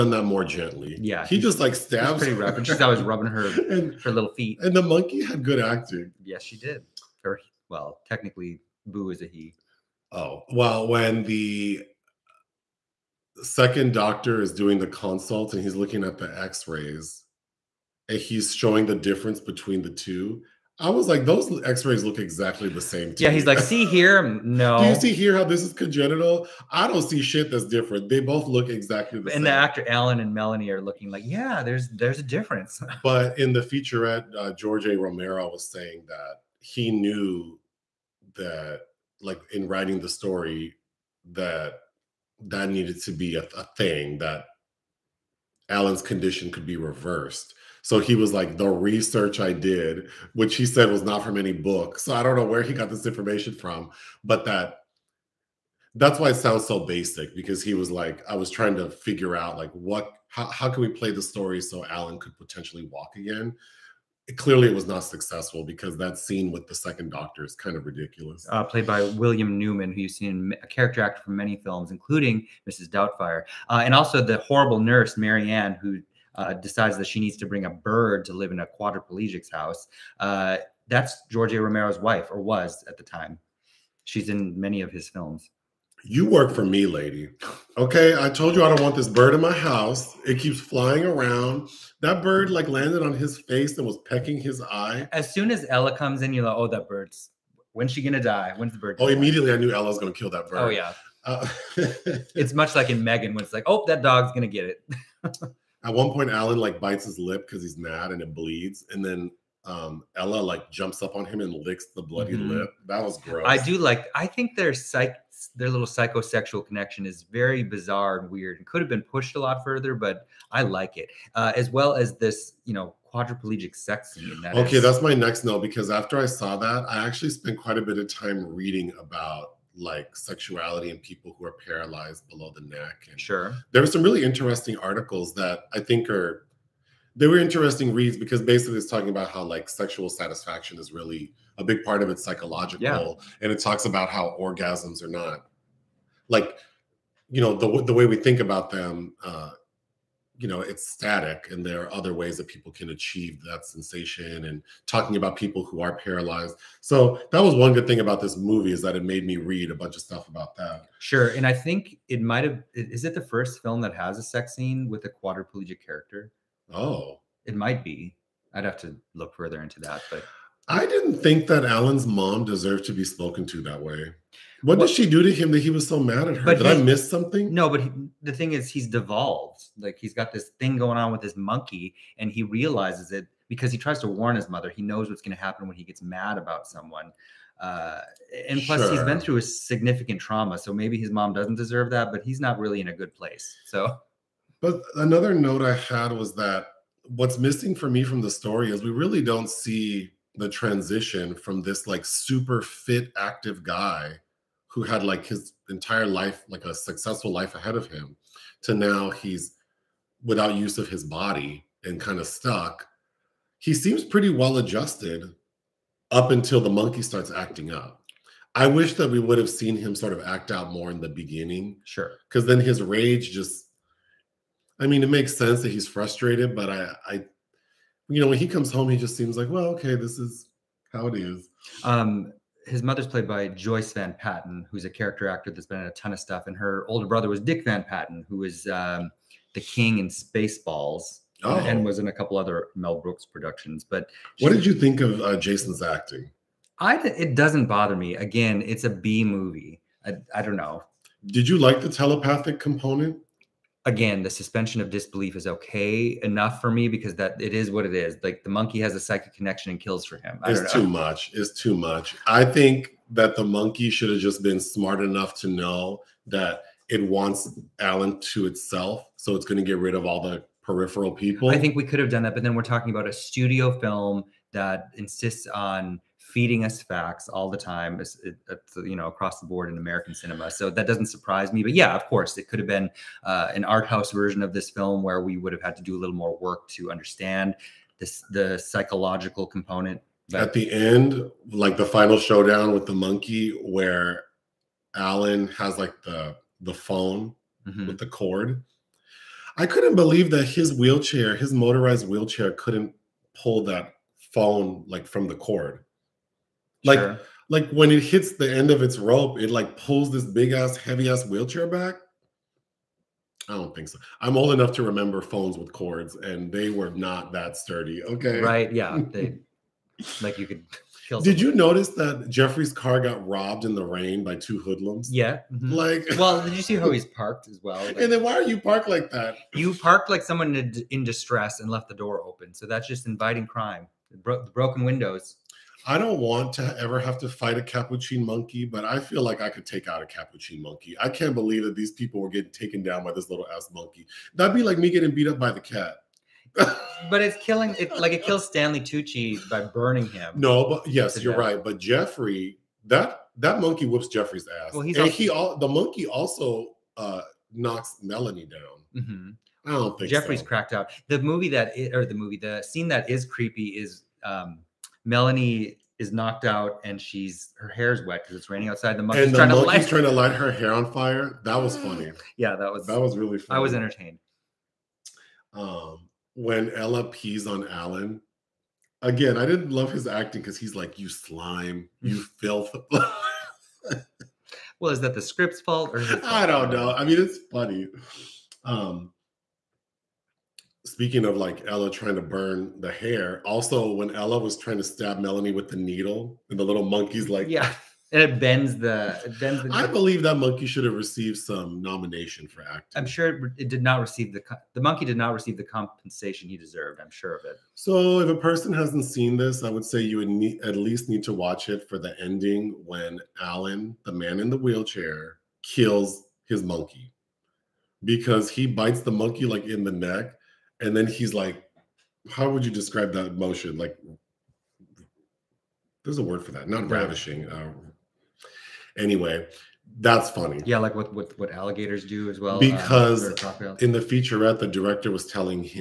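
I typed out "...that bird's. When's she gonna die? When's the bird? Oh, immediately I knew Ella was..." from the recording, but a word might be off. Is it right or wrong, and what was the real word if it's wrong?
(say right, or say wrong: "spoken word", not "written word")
right.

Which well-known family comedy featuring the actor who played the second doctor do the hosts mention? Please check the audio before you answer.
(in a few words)
Mrs. Doubtfire.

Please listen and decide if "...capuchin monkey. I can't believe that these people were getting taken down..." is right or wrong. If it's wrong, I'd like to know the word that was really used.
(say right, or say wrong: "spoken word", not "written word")
right.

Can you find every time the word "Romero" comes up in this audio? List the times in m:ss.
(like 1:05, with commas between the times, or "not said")
0:34, 1:21.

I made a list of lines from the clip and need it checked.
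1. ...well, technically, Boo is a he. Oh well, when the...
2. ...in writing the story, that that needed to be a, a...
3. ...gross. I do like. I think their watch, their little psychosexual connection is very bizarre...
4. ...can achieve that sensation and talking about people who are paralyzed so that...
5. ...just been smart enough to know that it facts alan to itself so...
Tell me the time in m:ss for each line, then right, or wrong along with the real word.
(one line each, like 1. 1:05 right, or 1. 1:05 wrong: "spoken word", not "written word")
1. 0:07 right
2. 0:39 right
3. 1:53 wrong: "psych", not "watch"
4. 2:32 right
5. 4:24 wrong: "wants", not "facts".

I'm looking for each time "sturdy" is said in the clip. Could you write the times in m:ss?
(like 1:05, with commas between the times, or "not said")
5:17.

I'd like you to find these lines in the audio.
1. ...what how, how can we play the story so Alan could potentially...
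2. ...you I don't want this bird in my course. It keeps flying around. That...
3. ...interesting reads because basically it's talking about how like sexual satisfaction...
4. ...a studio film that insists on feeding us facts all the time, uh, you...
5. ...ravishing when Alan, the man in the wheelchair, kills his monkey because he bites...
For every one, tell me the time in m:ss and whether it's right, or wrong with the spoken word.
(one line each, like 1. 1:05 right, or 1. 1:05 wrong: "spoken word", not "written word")
1. 0:59 right
2. 1:28 wrong: "house", not "course"
3. 2:17 right
4. 4:33 right
5. 6:52 wrong: "ending", not "ravishing".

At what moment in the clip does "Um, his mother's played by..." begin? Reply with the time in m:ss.
3:51.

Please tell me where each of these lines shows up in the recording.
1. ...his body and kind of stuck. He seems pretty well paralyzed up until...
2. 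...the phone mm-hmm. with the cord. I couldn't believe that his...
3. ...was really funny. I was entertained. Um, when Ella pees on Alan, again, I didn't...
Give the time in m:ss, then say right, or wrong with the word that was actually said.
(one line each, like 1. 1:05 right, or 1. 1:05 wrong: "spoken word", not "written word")
1. 3:30 wrong: "adjusted", not "paralyzed"
2. 4:56 right
3. 6:13 right.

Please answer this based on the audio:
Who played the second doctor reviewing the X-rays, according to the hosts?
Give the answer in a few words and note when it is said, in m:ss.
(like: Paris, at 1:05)
William Newman, at 1:09.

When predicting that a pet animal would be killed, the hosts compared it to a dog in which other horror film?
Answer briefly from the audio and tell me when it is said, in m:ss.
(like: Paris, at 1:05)
Megan, at 1:43.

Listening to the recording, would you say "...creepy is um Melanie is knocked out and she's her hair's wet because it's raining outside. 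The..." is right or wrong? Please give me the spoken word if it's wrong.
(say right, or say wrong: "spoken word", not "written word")
right.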